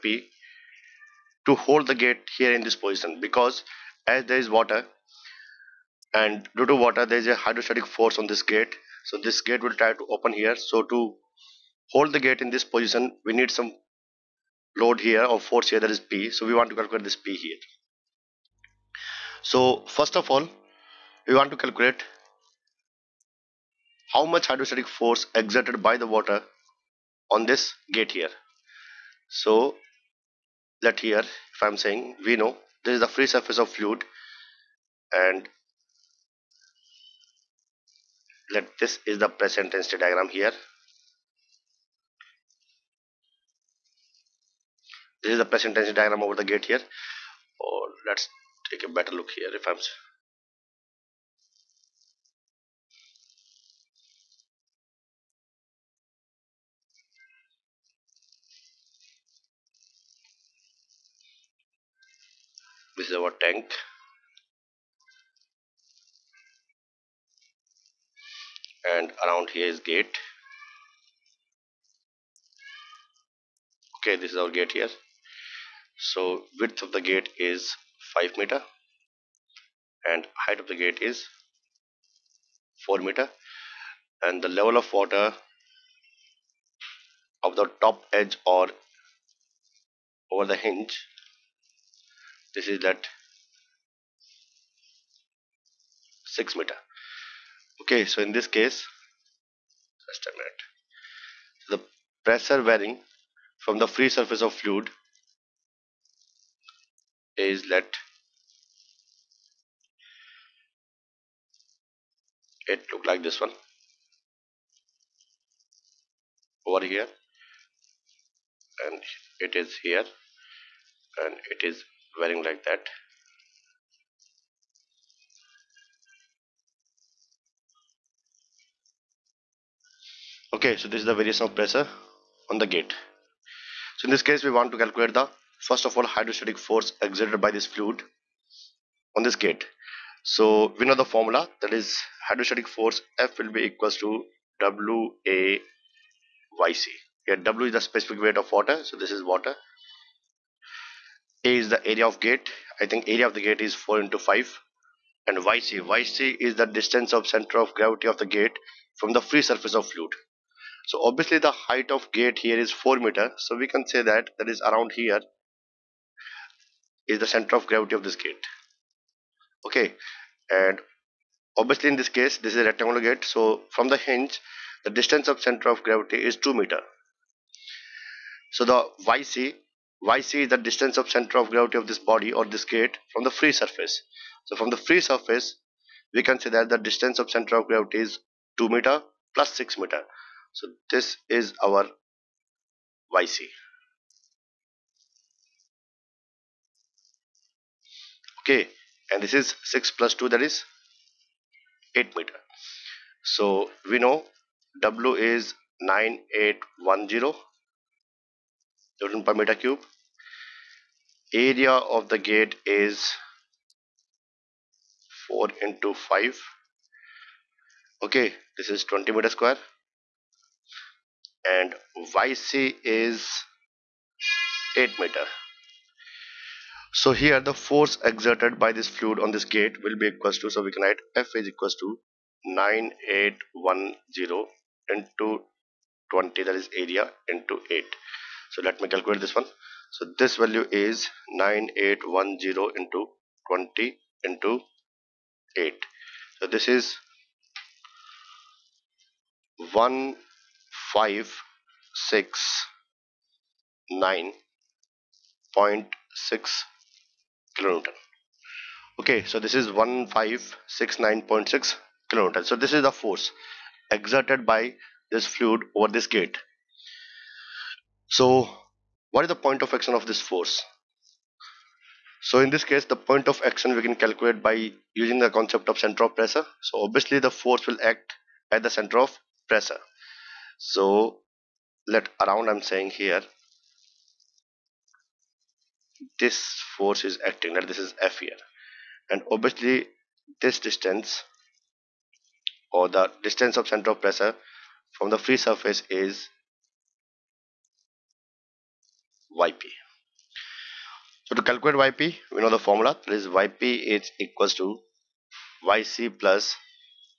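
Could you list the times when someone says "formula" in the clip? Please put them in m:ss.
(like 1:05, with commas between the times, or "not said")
2:21, 5:02.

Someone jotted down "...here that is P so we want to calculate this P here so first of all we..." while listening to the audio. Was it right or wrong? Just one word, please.
right.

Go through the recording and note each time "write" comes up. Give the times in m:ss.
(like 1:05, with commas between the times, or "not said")
3:50.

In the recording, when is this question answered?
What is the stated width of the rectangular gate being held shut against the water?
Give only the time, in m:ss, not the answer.
1:18.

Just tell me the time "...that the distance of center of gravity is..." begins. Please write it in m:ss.
3:06.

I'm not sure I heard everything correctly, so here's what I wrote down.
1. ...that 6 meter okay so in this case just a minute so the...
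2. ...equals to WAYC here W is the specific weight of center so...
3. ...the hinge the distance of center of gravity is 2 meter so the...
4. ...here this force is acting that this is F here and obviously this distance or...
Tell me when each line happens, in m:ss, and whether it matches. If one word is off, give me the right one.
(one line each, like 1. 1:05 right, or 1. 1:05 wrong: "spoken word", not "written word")
1. 1:32 right
2. 2:23 wrong: "water", not "center"
3. 2:53 right
4. 4:42 right.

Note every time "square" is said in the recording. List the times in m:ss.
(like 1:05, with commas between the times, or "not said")
3:39.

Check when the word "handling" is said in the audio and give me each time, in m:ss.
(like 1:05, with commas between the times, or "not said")
not said.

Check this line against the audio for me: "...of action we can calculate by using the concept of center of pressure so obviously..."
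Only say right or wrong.
right.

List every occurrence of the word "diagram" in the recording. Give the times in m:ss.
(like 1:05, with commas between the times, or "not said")
0:39, 0:46.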